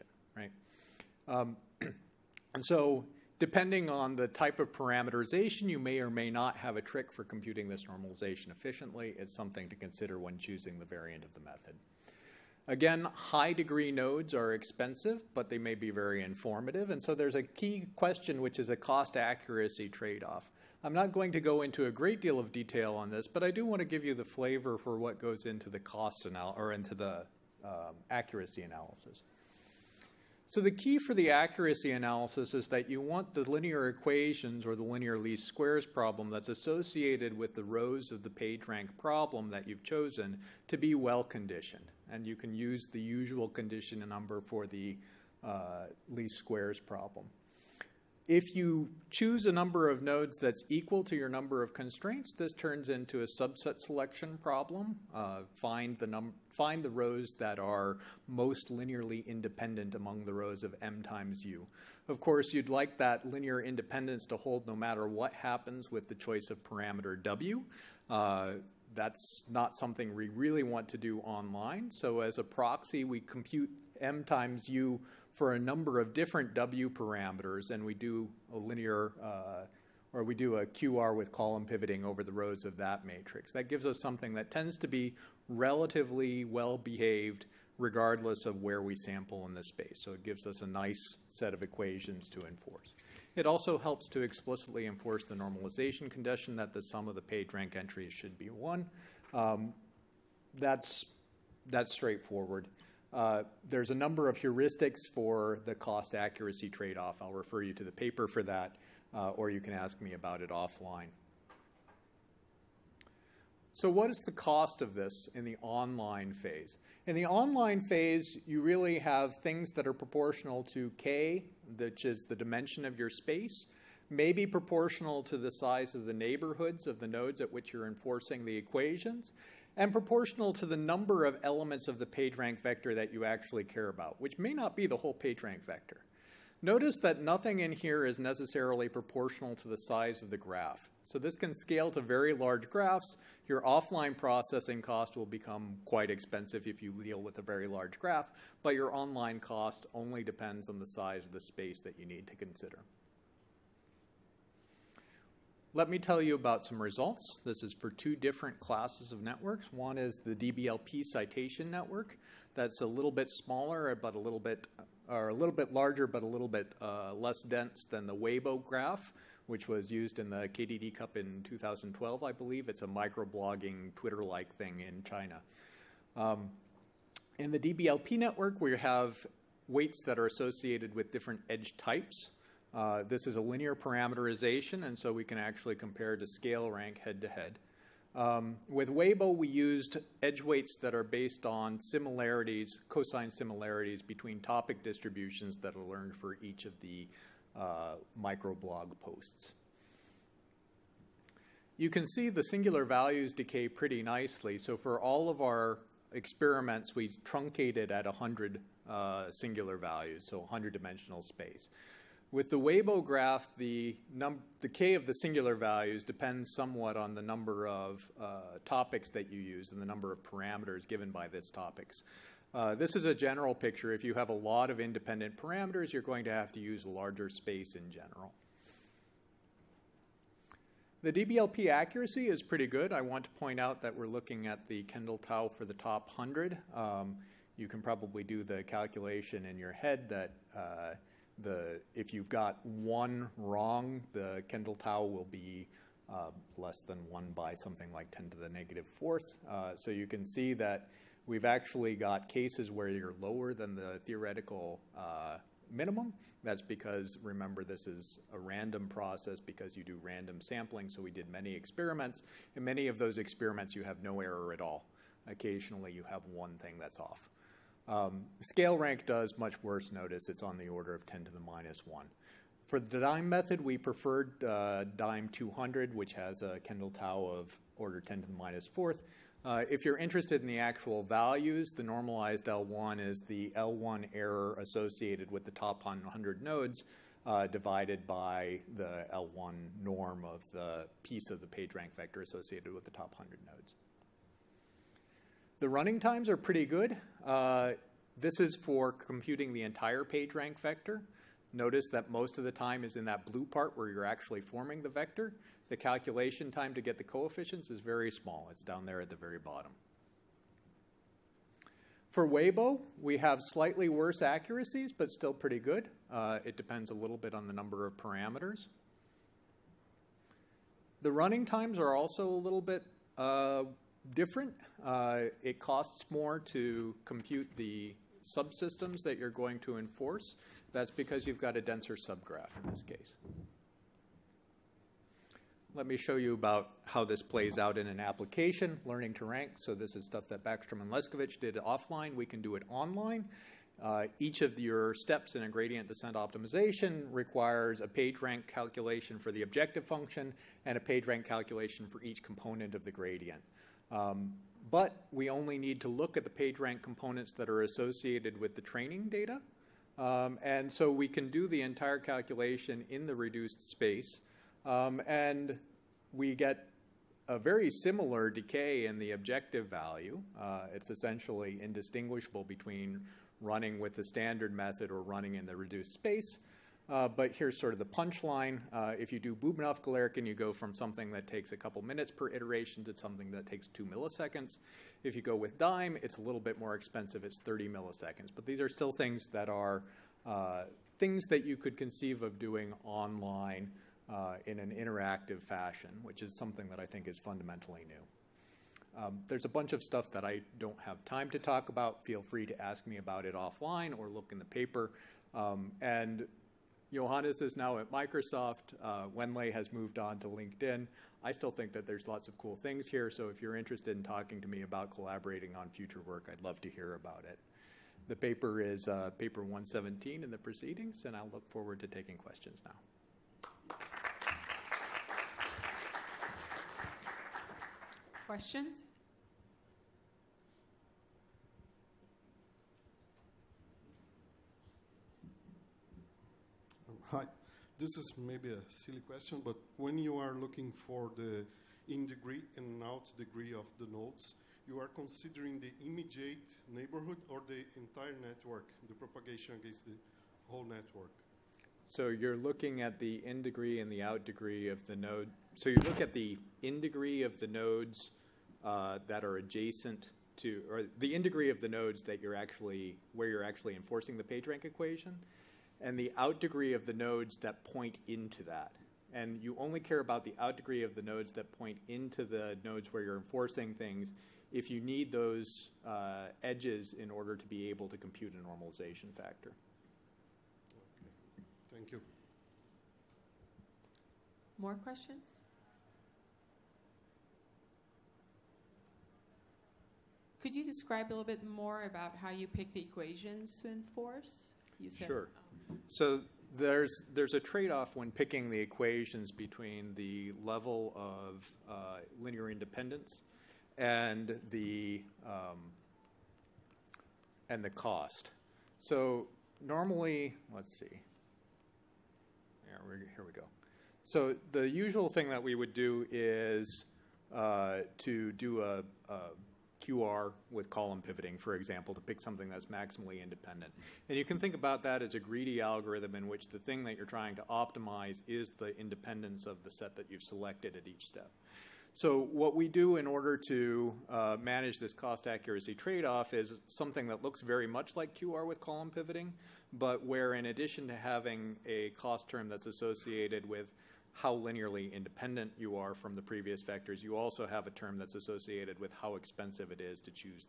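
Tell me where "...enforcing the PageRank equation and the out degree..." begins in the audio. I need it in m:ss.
7:43.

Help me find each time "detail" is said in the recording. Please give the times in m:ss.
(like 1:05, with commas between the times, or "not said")
0:22.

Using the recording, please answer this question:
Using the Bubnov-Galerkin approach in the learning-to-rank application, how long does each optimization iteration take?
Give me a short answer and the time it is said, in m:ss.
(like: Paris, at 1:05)
2 milliseconds, at 6:23.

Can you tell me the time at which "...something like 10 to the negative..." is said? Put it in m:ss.
4:07.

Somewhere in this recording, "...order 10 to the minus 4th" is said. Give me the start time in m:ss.
4:37.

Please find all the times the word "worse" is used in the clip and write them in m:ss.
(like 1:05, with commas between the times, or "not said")
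4:29, 5:13.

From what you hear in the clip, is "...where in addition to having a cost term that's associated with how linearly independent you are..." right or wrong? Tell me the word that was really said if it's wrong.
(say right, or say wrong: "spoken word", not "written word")
right.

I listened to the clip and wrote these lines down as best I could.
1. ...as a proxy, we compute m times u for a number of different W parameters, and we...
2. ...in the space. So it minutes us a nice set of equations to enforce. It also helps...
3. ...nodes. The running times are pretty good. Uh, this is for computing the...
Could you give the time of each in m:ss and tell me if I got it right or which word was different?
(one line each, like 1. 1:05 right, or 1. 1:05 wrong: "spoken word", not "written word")
1. 1:12 right
2. 1:29 wrong: "gives", not "minutes"
3. 4:53 right.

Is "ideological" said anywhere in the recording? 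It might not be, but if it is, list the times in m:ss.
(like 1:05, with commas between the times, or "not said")
not said.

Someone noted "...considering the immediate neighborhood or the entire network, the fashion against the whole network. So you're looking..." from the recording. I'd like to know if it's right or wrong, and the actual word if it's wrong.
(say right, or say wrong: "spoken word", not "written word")
wrong: "propagation", not "fashion".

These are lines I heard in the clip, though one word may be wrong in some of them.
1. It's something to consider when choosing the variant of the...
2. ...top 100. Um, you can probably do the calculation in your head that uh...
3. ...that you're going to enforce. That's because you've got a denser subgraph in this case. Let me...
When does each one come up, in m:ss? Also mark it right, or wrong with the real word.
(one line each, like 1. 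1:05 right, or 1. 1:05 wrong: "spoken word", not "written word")
1. 0:09 right
2. 3:55 right
3. 5:29 right.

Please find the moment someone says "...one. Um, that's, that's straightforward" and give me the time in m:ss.
1:38.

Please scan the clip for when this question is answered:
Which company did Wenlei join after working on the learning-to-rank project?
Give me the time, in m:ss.
6:50.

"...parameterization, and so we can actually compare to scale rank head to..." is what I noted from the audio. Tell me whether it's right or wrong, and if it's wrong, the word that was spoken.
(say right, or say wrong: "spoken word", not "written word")
right.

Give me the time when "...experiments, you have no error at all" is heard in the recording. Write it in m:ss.
4:23.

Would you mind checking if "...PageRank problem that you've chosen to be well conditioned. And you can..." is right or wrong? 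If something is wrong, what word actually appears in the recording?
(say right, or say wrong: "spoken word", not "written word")
right.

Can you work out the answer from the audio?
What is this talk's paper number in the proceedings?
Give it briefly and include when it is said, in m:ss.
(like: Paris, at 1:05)
117, at 6:59.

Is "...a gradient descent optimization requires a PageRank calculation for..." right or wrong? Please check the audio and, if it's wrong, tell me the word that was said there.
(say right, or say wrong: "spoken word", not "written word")
right.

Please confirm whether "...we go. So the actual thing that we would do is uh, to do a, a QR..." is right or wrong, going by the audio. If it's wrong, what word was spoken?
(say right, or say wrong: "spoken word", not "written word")
wrong: "usual", not "actual".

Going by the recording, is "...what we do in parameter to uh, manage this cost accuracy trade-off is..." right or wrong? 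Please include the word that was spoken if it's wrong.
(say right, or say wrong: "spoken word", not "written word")
wrong: "order", not "parameter".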